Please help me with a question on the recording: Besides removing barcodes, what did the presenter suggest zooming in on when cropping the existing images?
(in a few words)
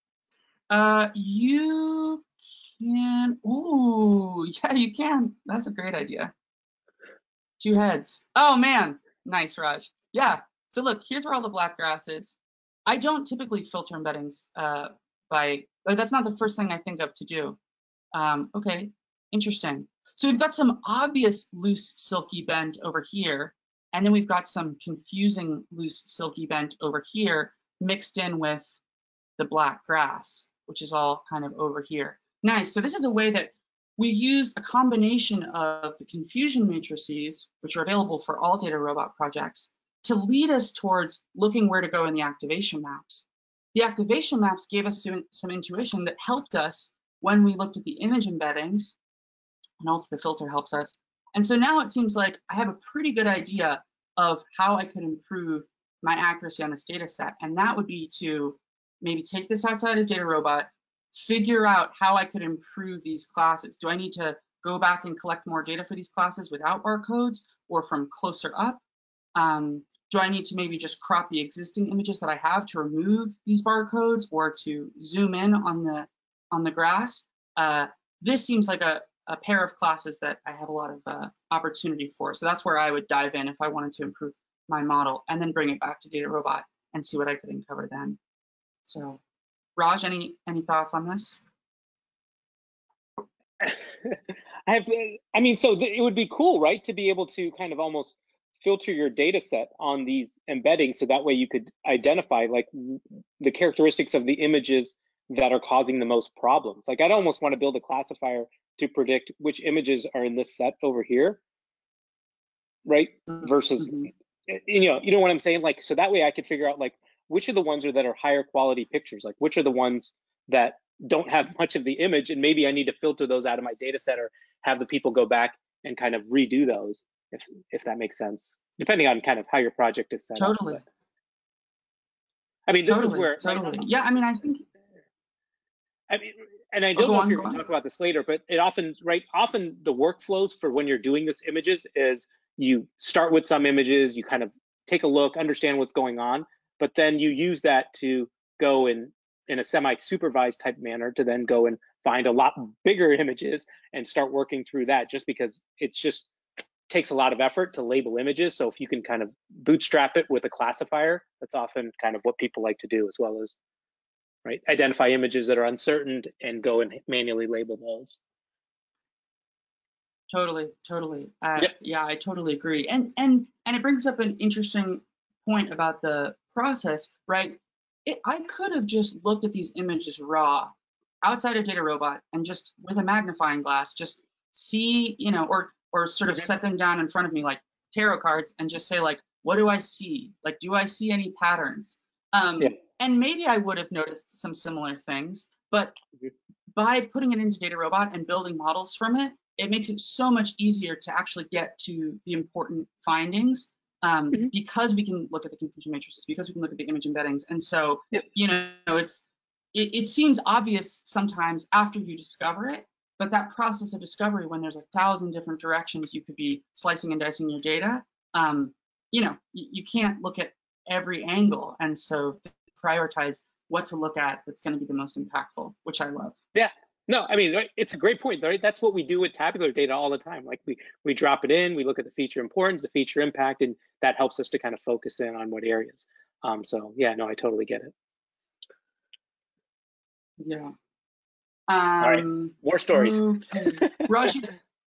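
The grass.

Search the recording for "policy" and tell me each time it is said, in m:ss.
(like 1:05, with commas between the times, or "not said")
not said.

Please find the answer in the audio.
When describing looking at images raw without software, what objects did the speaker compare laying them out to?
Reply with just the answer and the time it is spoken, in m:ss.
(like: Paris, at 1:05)
Tarot cards, at 3:07.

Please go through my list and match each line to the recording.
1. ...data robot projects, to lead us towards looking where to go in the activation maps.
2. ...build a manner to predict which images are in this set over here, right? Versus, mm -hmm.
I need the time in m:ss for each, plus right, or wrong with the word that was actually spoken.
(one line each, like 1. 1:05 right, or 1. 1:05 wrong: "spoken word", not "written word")
1. 0:38 right
2. 1:47 wrong: "classifier", not "manner".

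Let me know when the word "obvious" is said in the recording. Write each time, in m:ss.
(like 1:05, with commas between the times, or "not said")
0:20, 3:30.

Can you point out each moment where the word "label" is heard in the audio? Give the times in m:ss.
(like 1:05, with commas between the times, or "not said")
2:37, 2:47.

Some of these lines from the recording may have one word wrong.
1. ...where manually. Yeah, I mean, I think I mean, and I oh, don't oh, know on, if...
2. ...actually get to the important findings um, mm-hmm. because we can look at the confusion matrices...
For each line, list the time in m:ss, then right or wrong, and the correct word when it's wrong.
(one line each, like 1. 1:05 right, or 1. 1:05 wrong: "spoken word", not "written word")
1. 2:13 wrong: "totally", not "manually"
2. 3:21 right.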